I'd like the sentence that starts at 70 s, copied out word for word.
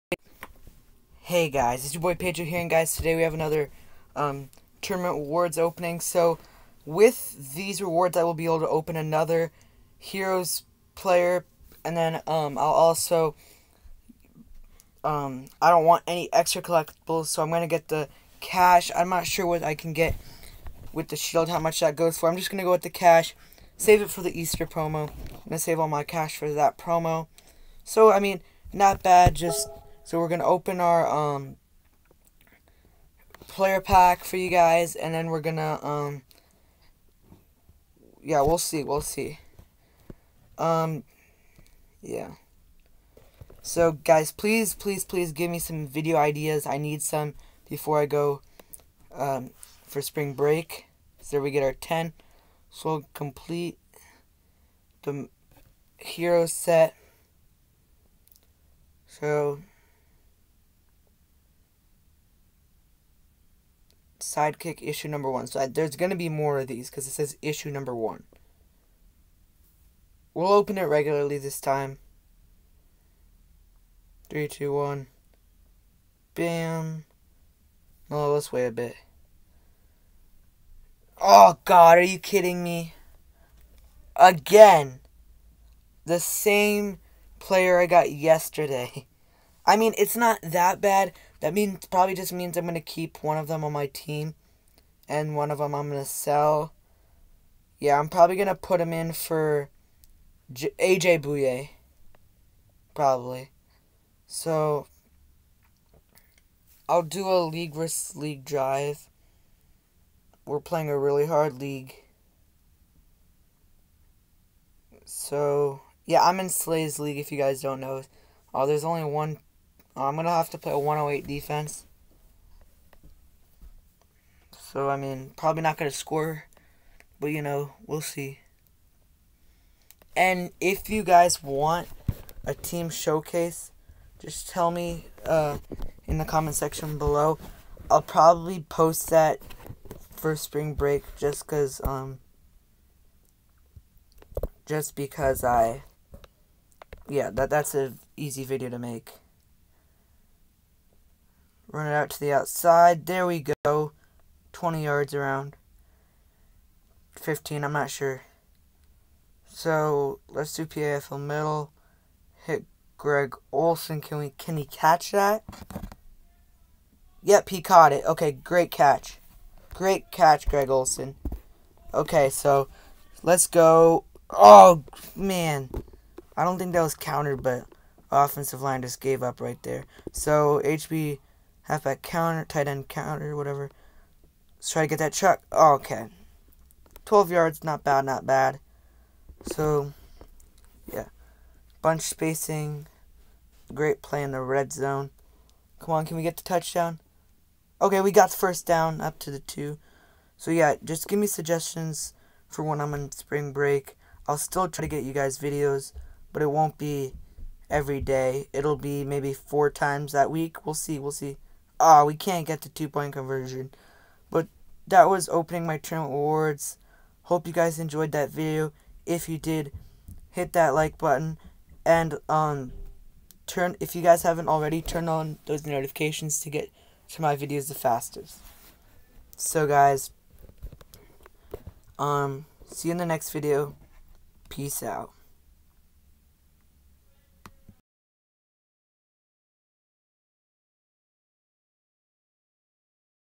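We'll open it regularly this time.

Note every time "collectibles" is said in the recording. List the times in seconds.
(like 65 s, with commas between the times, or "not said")
16 s.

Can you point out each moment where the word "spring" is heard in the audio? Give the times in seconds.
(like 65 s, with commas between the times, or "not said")
50 s, 140 s, 203 s.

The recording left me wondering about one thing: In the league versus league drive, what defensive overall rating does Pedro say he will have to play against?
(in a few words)
108.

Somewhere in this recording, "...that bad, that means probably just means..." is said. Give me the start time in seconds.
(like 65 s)
90 s.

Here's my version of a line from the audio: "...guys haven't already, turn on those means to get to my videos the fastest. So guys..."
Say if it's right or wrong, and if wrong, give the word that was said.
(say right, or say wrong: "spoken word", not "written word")
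wrong: "notifications", not "means".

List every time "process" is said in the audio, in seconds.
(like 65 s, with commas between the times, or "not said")
not said.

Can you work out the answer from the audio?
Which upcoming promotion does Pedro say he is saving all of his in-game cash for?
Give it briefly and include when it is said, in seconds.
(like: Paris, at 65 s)
Easter promo, at 24 s.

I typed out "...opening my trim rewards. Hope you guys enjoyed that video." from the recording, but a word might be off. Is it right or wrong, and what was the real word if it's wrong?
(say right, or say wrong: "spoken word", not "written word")
wrong: "awards", not "rewards".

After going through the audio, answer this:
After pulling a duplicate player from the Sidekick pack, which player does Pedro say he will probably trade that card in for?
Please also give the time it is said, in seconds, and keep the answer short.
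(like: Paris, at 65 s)
AJ Bouye, at 100 s.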